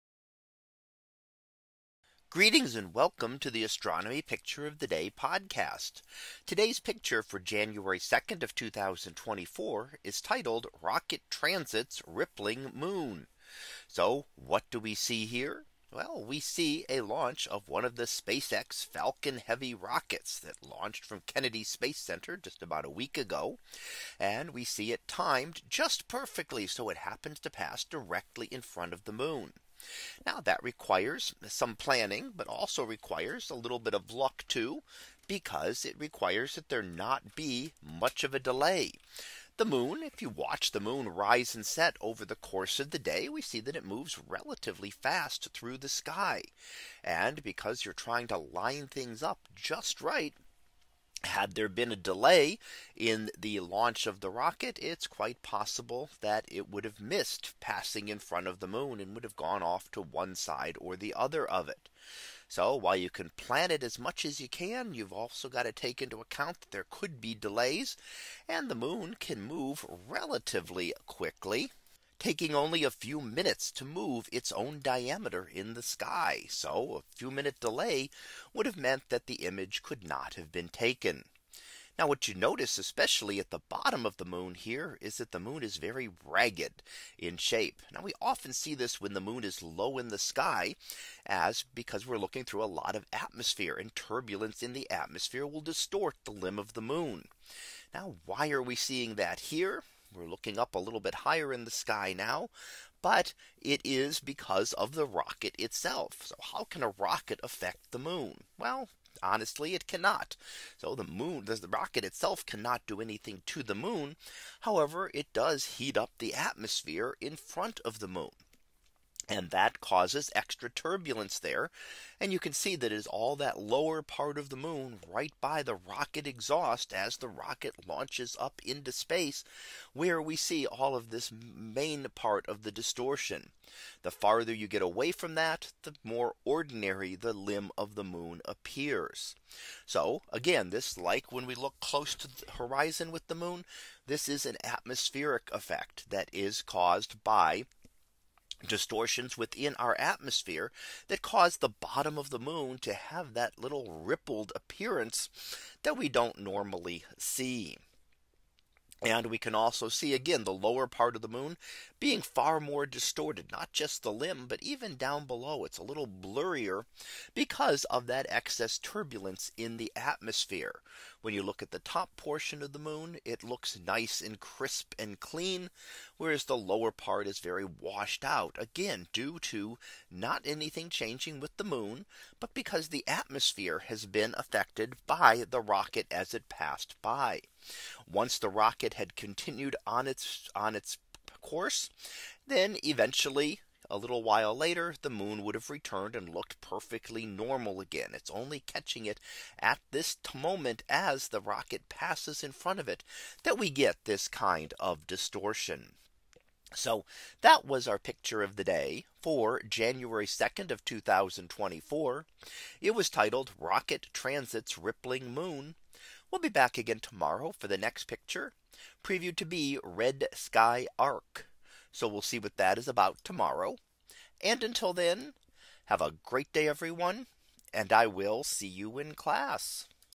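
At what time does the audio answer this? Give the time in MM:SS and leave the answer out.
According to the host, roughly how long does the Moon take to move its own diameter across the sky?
01:12.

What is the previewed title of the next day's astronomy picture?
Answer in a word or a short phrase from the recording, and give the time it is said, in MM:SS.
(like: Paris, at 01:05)
Red Sky Arc, at 03:39.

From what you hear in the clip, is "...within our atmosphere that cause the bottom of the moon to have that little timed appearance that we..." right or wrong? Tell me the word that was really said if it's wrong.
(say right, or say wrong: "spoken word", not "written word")
wrong: "rippled", not "timed".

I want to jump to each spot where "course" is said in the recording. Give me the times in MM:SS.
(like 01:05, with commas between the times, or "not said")
00:42, 03:11.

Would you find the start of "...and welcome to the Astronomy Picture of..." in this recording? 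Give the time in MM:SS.
00:02.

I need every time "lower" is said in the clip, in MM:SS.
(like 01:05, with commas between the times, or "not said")
02:03, 02:40, 02:56.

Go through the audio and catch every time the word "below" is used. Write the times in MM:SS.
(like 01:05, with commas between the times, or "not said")
02:45.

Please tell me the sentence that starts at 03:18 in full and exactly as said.
It's only catching it at this moment as the rocket passes in front of it that we get this kind of distortion.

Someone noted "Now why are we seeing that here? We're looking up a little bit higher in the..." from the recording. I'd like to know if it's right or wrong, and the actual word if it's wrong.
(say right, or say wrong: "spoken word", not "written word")
right.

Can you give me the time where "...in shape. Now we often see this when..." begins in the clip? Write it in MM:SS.
01:27.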